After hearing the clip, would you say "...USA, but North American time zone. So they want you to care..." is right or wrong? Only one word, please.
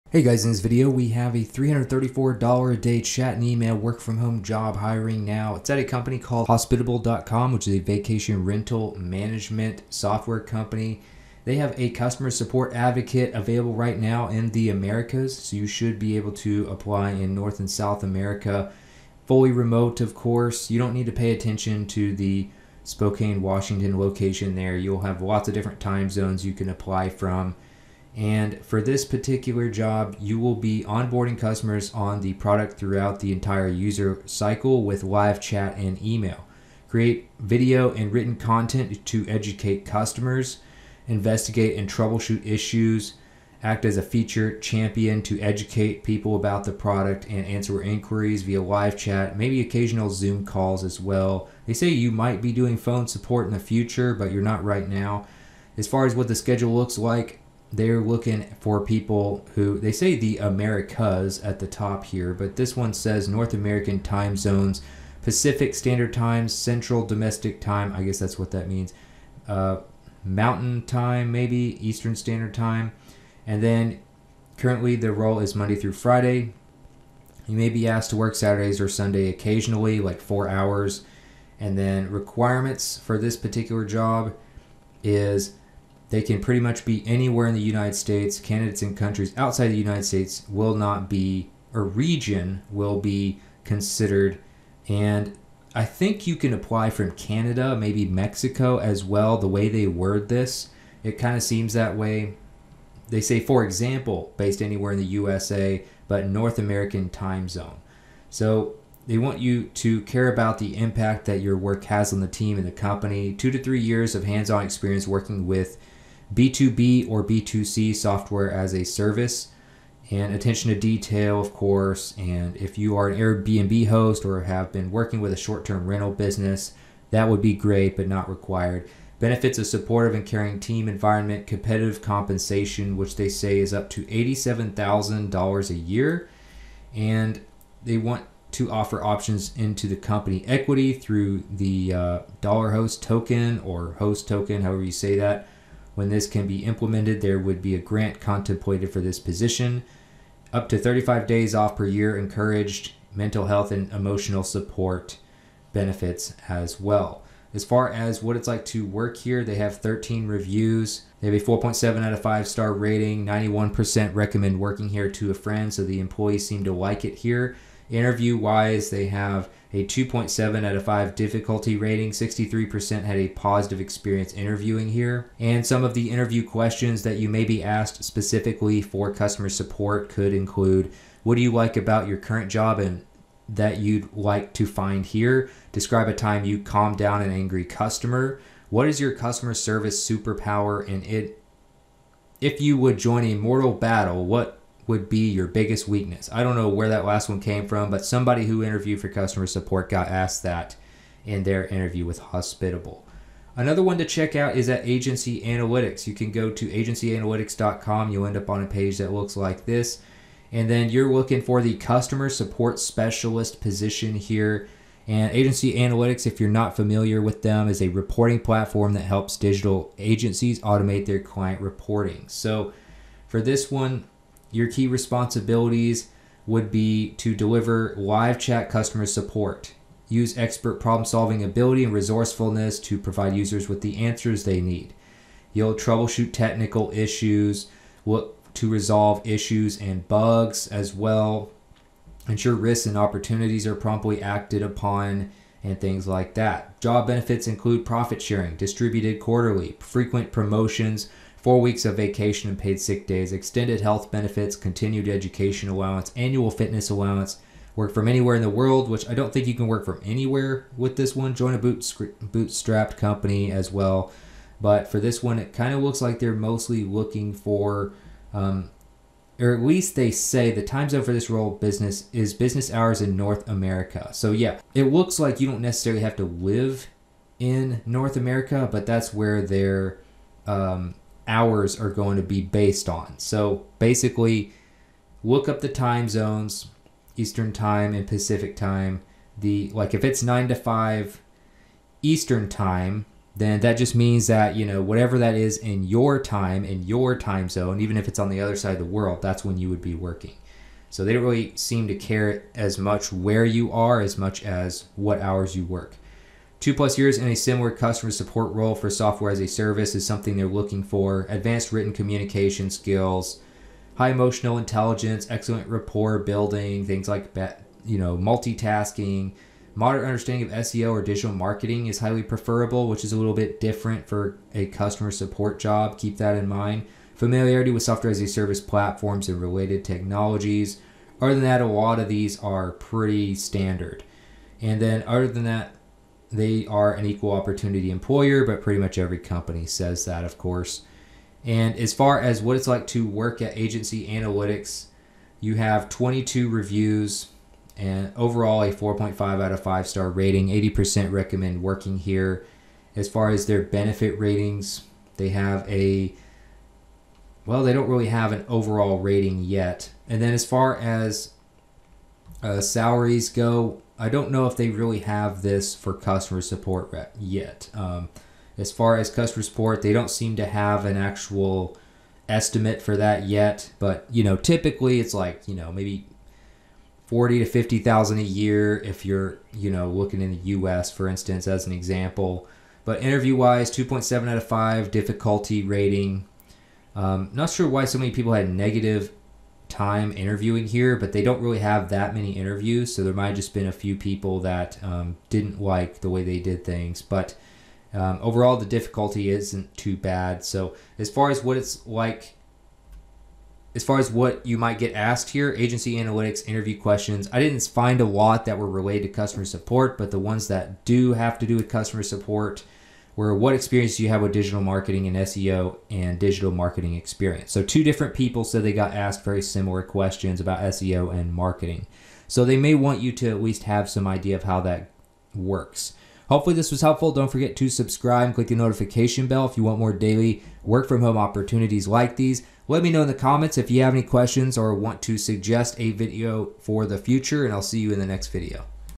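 right.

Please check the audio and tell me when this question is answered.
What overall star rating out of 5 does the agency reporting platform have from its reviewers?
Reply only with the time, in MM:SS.
05:48.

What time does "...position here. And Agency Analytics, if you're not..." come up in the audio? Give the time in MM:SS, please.
03:33.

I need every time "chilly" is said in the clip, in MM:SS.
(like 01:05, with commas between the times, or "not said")
not said.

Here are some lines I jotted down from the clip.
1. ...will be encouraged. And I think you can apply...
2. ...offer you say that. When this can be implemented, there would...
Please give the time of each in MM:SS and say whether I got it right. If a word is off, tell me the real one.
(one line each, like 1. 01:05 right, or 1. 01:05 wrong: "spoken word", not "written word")
1. 01:32 wrong: "considered", not "encouraged"
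2. 02:24 wrong: "however", not "offer".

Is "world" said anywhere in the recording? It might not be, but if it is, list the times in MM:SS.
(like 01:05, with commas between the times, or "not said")
04:18, 04:58.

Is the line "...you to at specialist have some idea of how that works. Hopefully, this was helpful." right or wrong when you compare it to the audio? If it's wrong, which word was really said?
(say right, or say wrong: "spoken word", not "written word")
wrong: "least", not "specialist".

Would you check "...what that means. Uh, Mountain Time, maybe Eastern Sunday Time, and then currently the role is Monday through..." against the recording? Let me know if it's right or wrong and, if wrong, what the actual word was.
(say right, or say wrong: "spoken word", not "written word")
wrong: "Standard", not "Sunday".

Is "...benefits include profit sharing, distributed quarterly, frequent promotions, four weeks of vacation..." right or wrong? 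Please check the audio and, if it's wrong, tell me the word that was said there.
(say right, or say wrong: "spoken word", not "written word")
right.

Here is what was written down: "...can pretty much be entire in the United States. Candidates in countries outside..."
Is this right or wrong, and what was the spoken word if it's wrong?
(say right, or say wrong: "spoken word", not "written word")
wrong: "anywhere", not "entire".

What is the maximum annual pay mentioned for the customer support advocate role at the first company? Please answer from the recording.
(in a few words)
$87,000.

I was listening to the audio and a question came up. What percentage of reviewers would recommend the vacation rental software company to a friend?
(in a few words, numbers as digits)
91%.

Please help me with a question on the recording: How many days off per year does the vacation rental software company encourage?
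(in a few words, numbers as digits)
35.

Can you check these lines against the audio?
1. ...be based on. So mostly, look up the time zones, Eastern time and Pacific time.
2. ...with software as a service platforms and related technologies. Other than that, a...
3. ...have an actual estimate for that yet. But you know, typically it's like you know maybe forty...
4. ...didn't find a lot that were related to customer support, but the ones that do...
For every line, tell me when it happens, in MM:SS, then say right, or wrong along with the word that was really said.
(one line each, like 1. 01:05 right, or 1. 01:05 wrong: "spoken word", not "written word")
1. 04:42 wrong: "basically", not "mostly"
2. 05:27 right
3. 06:10 right
4. 06:47 right.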